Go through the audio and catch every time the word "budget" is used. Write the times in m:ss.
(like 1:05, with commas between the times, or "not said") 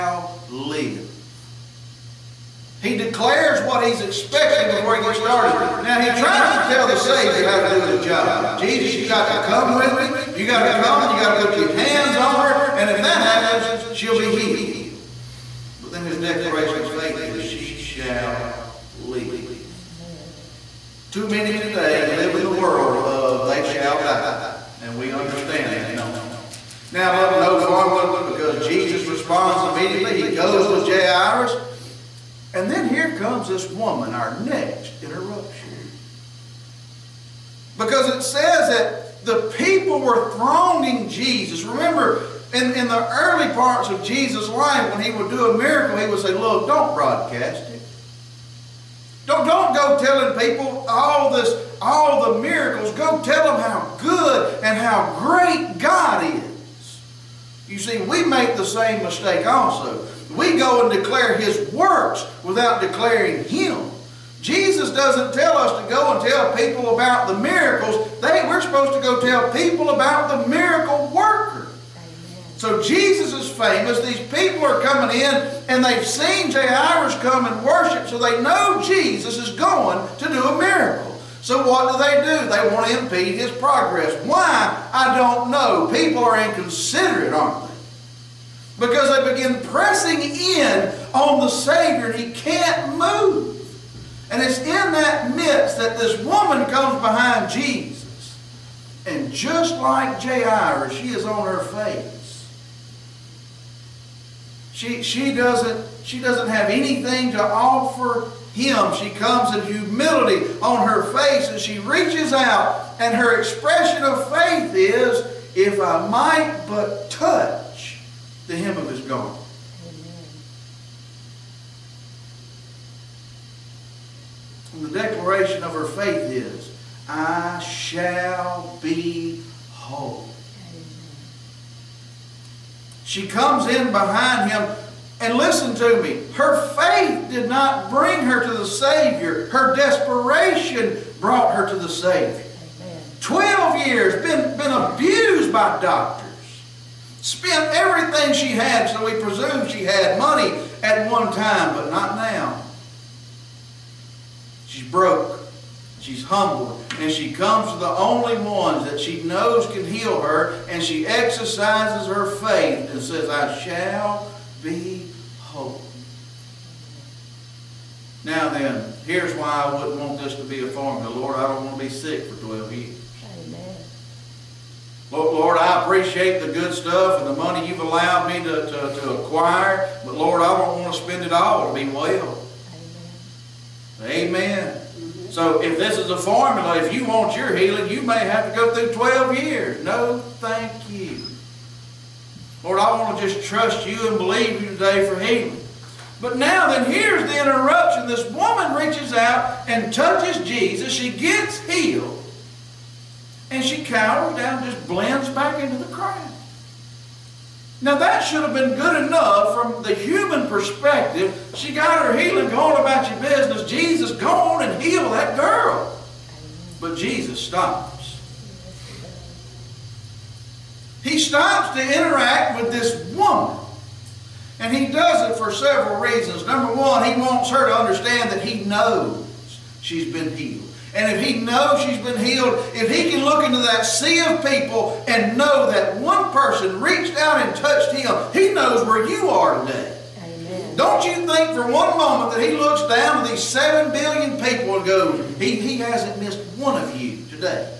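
not said.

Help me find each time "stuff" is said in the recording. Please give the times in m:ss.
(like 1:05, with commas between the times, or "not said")
2:56.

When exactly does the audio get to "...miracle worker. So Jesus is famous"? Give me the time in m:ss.
1:10.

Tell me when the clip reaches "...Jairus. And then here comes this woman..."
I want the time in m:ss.
0:30.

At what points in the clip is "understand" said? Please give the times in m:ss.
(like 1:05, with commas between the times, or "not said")
0:25, 3:47.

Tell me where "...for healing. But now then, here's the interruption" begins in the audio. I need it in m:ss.
3:15.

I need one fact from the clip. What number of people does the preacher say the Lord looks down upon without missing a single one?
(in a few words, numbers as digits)
7 billion.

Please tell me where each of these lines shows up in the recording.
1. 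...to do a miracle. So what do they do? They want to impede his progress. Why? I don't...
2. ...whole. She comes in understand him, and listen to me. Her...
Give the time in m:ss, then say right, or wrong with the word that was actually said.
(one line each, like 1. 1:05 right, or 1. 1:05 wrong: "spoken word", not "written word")
1. 1:20 right
2. 2:09 wrong: "behind", not "understand".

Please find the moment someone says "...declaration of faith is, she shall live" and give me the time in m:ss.
0:16.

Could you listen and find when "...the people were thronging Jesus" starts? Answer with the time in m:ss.
0:39.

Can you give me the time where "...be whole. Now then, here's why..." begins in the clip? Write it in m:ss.
2:44.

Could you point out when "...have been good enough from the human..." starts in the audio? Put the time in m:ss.
3:28.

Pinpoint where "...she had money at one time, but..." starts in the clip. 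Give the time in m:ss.
2:29.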